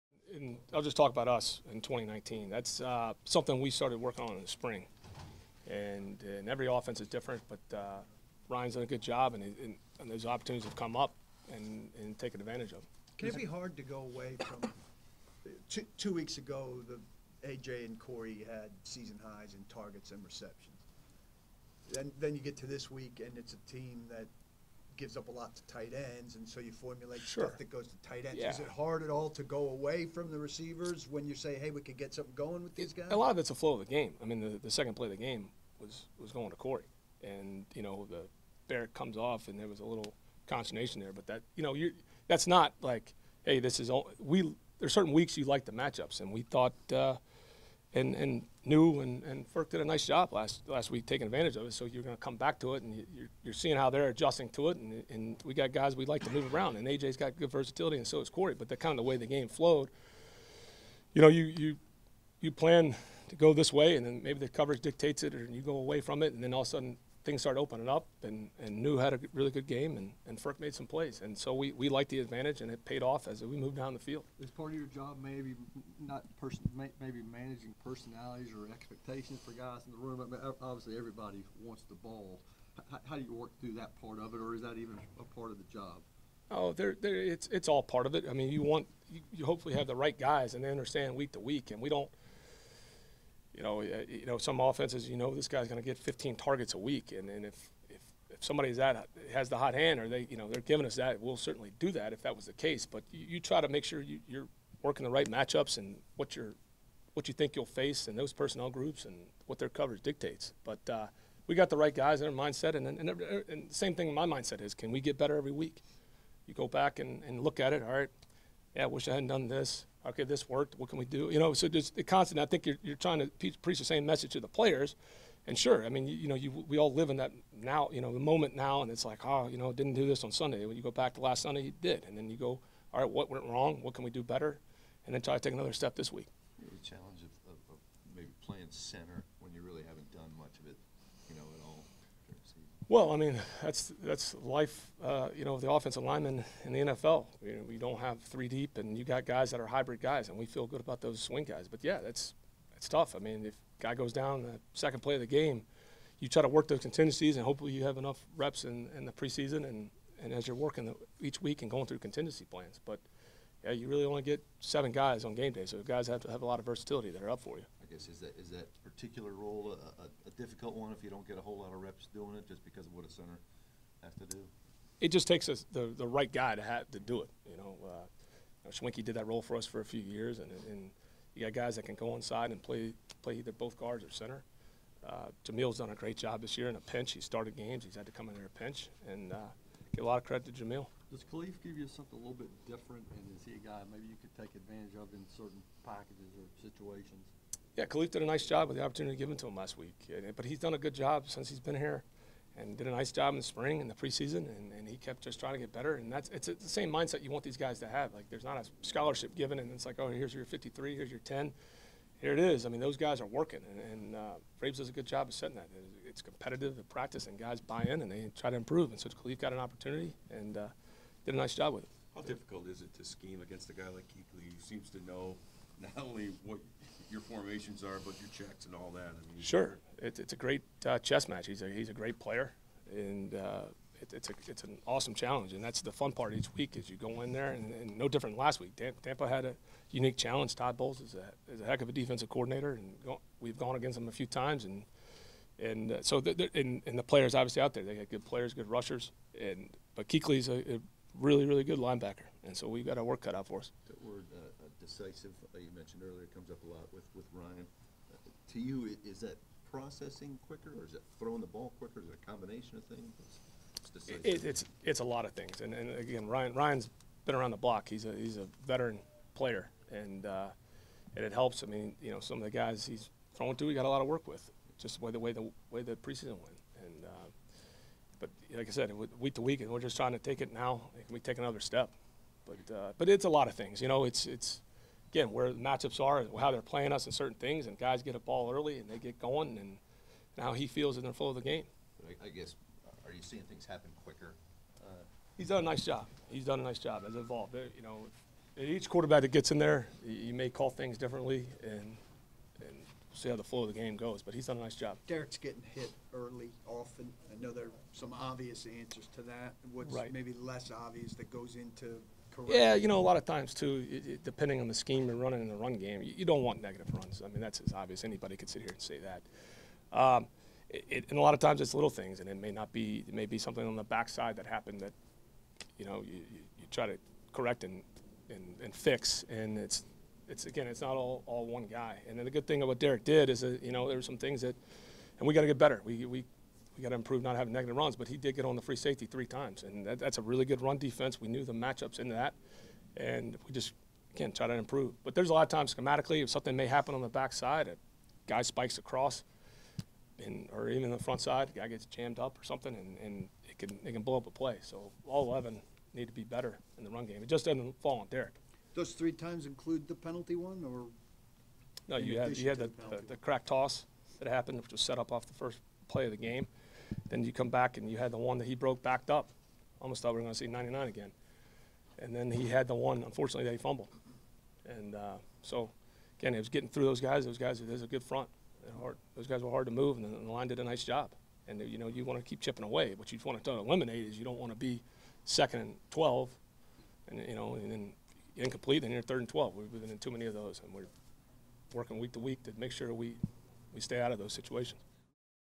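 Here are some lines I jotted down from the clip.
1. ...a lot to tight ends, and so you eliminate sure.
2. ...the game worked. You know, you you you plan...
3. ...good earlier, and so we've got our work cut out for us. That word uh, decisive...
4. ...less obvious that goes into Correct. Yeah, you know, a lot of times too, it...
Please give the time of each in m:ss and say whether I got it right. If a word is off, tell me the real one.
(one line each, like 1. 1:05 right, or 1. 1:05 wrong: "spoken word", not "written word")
1. 0:25 wrong: "formulate", not "eliminate"
2. 0:59 wrong: "flowed", not "worked"
3. 4:11 wrong: "linebacker", not "earlier"
4. 5:10 right.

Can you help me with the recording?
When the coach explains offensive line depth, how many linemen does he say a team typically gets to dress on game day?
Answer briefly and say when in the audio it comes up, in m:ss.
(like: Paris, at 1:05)
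7, at 2:44.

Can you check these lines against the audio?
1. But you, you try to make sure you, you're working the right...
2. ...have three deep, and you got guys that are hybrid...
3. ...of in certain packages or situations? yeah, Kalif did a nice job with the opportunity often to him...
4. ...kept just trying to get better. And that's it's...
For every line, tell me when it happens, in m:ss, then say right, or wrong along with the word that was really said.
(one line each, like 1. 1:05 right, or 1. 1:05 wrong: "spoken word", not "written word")
1. 1:42 right
2. 2:28 right
3. 3:14 wrong: "given", not "often"
4. 3:24 right.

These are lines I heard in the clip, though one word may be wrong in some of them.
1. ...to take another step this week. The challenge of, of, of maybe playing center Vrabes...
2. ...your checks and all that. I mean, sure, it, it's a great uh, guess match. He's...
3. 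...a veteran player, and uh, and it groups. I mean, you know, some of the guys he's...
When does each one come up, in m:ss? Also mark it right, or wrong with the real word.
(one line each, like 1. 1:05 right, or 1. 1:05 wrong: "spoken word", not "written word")
1. 2:15 wrong: "Well", not "Vrabes"
2. 3:48 wrong: "chess", not "guess"
3. 4:28 wrong: "helps", not "groups".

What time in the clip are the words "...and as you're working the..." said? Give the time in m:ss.
2:40.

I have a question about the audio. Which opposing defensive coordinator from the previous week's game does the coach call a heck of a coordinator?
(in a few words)
Todd Bowles.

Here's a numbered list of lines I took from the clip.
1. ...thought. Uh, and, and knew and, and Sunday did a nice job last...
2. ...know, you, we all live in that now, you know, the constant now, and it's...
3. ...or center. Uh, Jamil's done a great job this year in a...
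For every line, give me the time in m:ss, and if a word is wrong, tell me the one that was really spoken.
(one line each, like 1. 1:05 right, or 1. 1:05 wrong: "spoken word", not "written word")
1. 0:46 wrong: "Firk", not "Sunday"
2. 2:06 wrong: "moment", not "constant"
3. 3:04 right.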